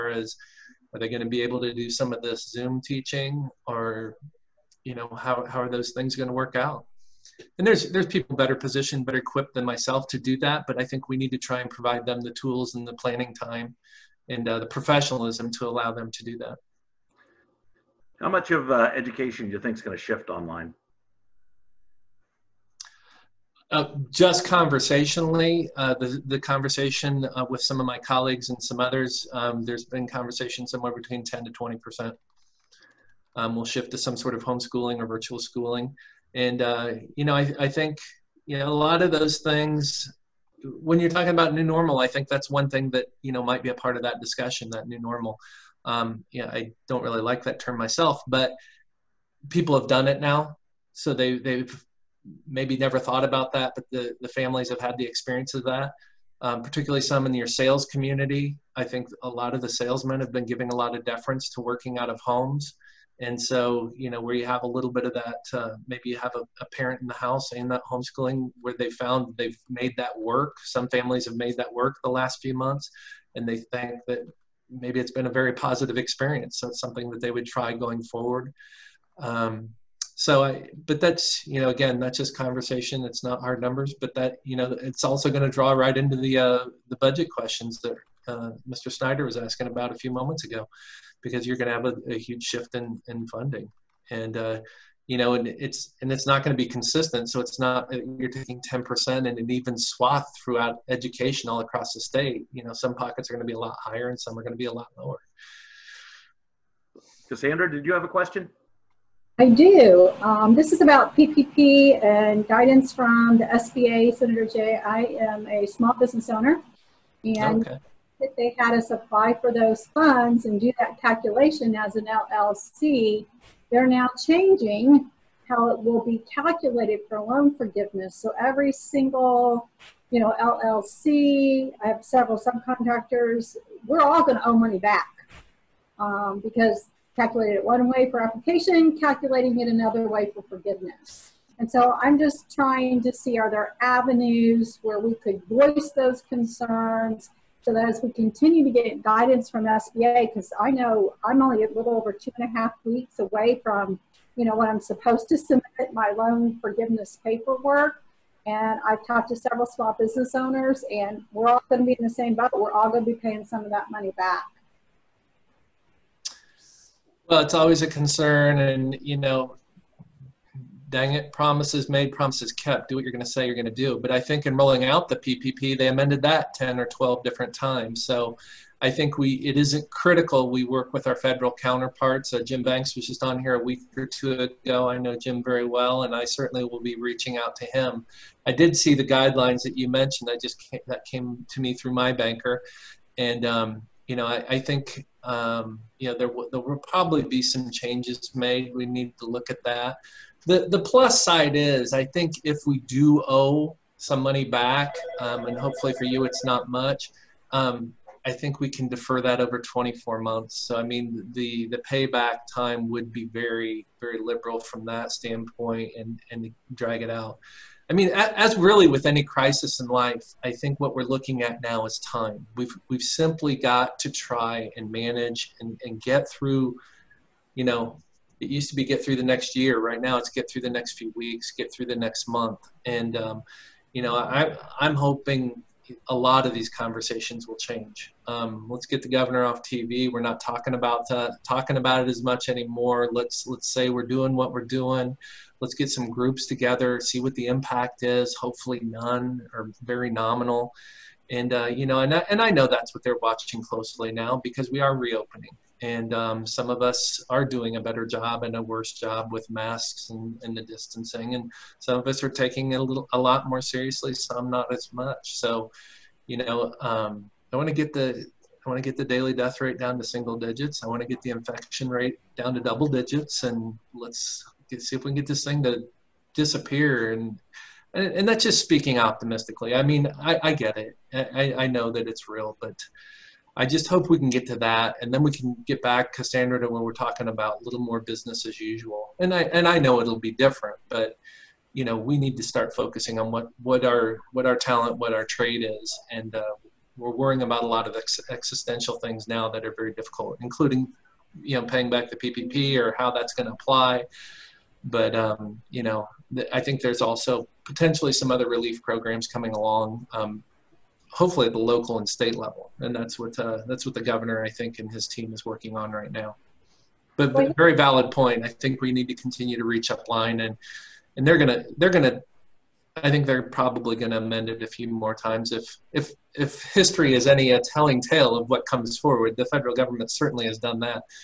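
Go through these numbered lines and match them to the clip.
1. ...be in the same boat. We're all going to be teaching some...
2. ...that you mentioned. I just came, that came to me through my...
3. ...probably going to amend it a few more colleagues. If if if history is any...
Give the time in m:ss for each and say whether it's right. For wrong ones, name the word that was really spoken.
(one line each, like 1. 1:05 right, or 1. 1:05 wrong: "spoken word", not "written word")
1. 2:41 wrong: "paying", not "teaching"
2. 3:09 right
3. 5:23 wrong: "times", not "colleagues".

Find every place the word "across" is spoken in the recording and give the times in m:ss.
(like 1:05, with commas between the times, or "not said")
1:41.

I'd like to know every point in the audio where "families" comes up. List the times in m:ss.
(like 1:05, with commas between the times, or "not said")
0:54, 1:10.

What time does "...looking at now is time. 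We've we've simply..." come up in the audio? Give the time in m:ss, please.
3:41.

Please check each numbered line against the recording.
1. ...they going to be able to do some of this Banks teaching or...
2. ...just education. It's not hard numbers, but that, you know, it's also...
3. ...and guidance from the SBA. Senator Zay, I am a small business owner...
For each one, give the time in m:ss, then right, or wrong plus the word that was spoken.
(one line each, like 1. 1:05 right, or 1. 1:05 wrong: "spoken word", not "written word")
1. 0:00 wrong: "Zoom", not "Banks"
2. 1:22 wrong: "conversation", not "education"
3. 1:52 right.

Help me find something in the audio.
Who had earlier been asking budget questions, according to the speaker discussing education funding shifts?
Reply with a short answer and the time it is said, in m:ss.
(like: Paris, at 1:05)
Mr. Snyder, at 1:28.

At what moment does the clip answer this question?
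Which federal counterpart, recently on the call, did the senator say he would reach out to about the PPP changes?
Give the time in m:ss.
3:02.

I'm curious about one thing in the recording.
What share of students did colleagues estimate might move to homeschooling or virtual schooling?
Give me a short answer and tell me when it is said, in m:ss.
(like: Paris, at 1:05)
10 to 20 percent, at 0:31.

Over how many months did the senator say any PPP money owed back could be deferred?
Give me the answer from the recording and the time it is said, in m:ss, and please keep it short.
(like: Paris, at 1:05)
24 months, at 3:29.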